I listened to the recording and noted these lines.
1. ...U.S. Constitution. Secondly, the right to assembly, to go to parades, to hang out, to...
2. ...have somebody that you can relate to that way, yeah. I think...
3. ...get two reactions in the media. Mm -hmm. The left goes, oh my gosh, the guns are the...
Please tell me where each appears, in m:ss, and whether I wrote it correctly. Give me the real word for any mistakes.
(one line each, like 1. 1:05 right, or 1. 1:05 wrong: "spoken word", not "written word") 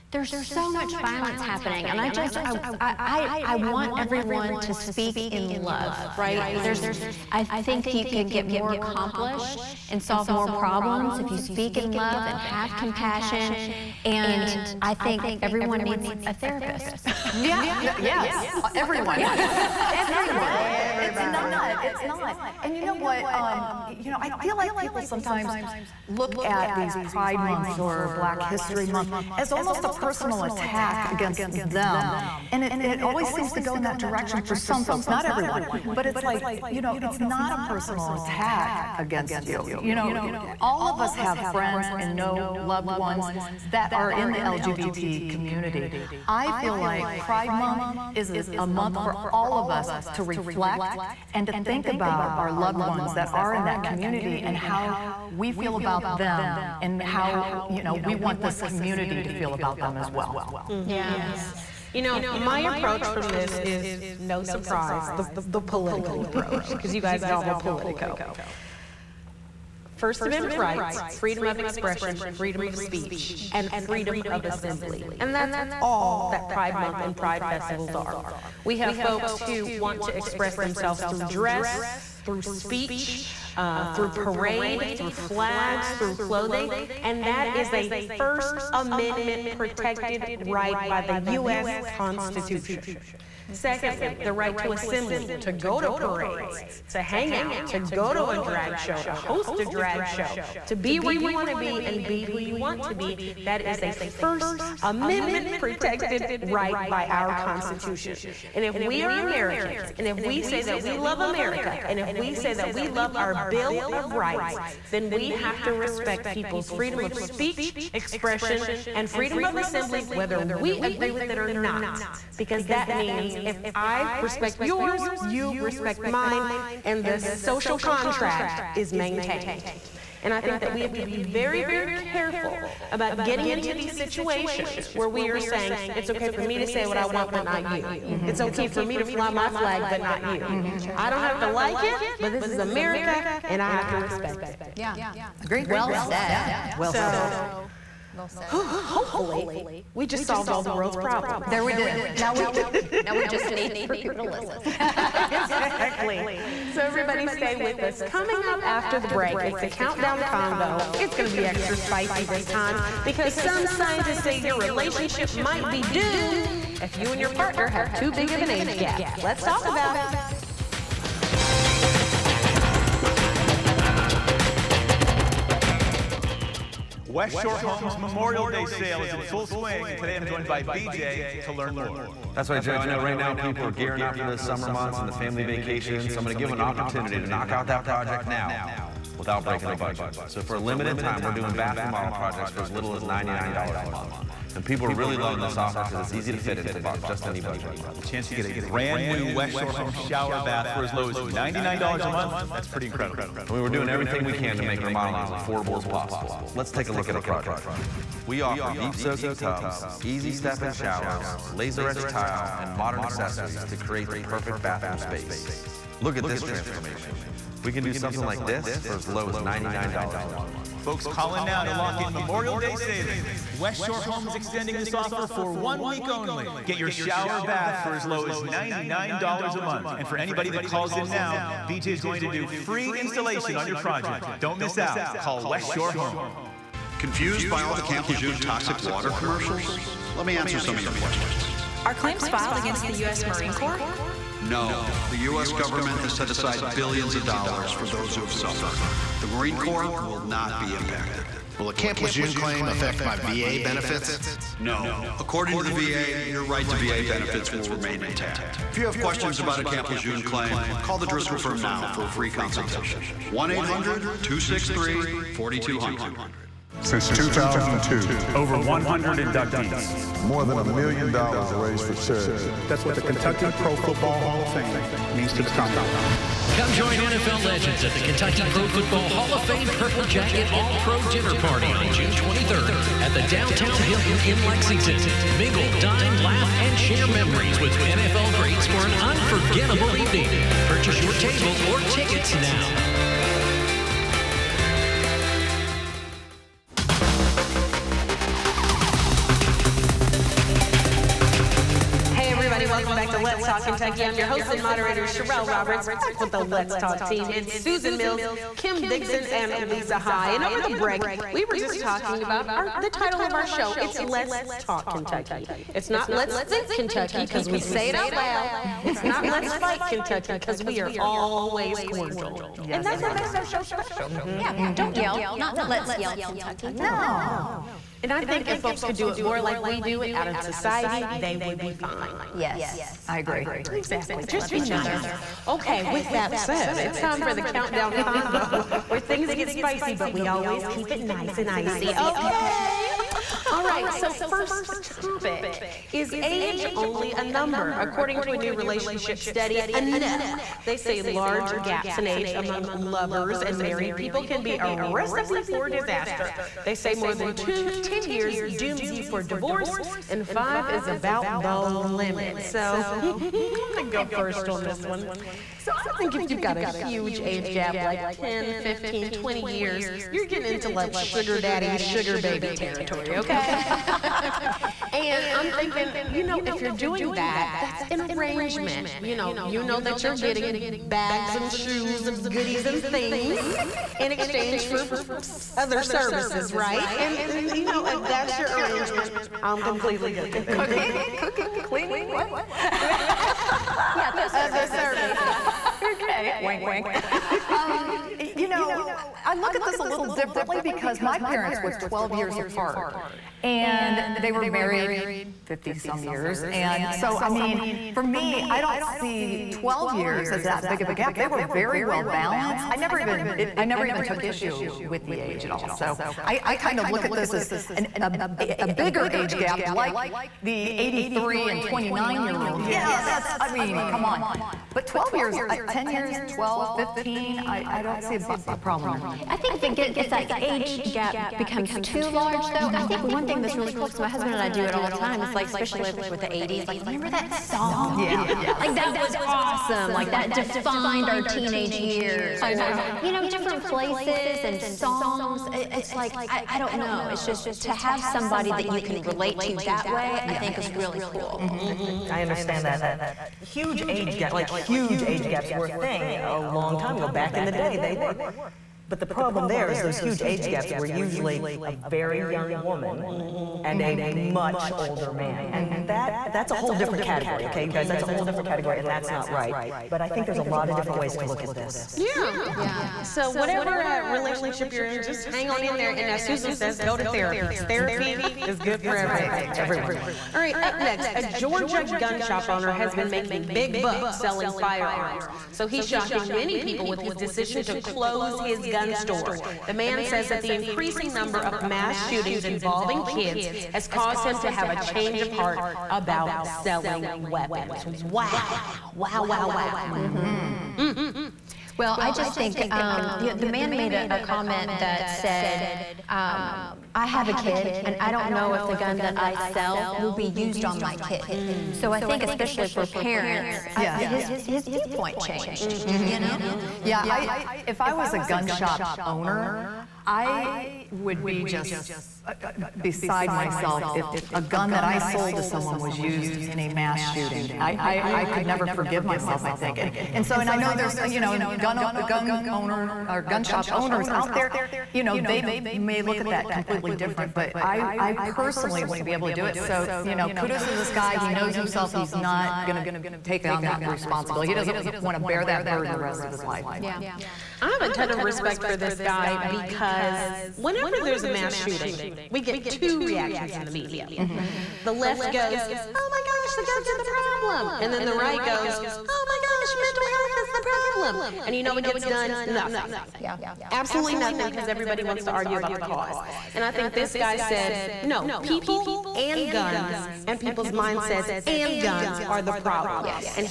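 1. 1:31 right
2. 7:27 right
3. 9:12 right.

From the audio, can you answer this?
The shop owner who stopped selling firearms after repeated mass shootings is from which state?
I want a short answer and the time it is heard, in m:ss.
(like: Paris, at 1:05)
Georgia, at 8:01.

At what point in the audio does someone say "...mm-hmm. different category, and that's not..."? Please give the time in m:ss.
7:48.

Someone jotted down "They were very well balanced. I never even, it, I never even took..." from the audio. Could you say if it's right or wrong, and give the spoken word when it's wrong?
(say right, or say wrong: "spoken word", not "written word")
right.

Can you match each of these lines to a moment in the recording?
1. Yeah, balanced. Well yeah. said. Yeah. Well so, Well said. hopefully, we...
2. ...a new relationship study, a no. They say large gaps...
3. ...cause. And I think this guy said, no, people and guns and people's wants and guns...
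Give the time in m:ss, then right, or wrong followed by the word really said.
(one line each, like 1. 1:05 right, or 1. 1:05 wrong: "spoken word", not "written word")
1. 2:24 wrong: "agreed", not "balanced"
2. 5:48 right
3. 9:25 wrong: "mindsets", not "wants".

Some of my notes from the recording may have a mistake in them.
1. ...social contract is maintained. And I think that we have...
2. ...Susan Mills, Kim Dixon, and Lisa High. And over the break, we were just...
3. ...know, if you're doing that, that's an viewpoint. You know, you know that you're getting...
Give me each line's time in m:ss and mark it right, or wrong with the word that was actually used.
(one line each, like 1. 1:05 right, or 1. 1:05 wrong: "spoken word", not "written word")
1. 2:07 right
2. 5:07 right
3. 6:16 wrong: "arrangement", not "viewpoint".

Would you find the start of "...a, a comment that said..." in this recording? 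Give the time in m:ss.
8:24.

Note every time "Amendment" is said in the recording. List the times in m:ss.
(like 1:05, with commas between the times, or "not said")
1:10, 1:28, 1:44.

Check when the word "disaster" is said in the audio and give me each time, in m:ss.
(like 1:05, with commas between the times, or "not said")
5:55.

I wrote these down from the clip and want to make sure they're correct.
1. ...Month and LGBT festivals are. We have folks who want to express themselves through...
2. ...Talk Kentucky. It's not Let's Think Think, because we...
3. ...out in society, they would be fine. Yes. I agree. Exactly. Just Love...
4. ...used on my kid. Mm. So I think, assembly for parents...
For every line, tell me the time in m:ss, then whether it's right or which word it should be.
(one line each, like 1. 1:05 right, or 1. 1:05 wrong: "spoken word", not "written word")
1. 1:16 wrong: "Pride", not "LGBT"
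2. 5:14 wrong: "Kentucky", not "Think"
3. 5:30 right
4. 8:30 wrong: "especially", not "assembly".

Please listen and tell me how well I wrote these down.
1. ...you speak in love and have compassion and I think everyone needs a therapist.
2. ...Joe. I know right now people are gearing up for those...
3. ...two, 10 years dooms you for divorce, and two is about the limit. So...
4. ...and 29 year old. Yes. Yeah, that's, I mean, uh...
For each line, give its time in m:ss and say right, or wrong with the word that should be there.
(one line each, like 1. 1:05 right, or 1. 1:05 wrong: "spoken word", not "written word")
1. 0:11 right
2. 3:02 right
3. 5:57 wrong: "five", not "two"
4. 7:01 right.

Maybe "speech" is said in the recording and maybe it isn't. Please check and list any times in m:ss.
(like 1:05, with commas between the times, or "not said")
1:12, 1:22, 1:57.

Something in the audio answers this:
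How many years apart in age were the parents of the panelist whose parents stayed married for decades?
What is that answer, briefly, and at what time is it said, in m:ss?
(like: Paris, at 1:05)
12, at 6:41.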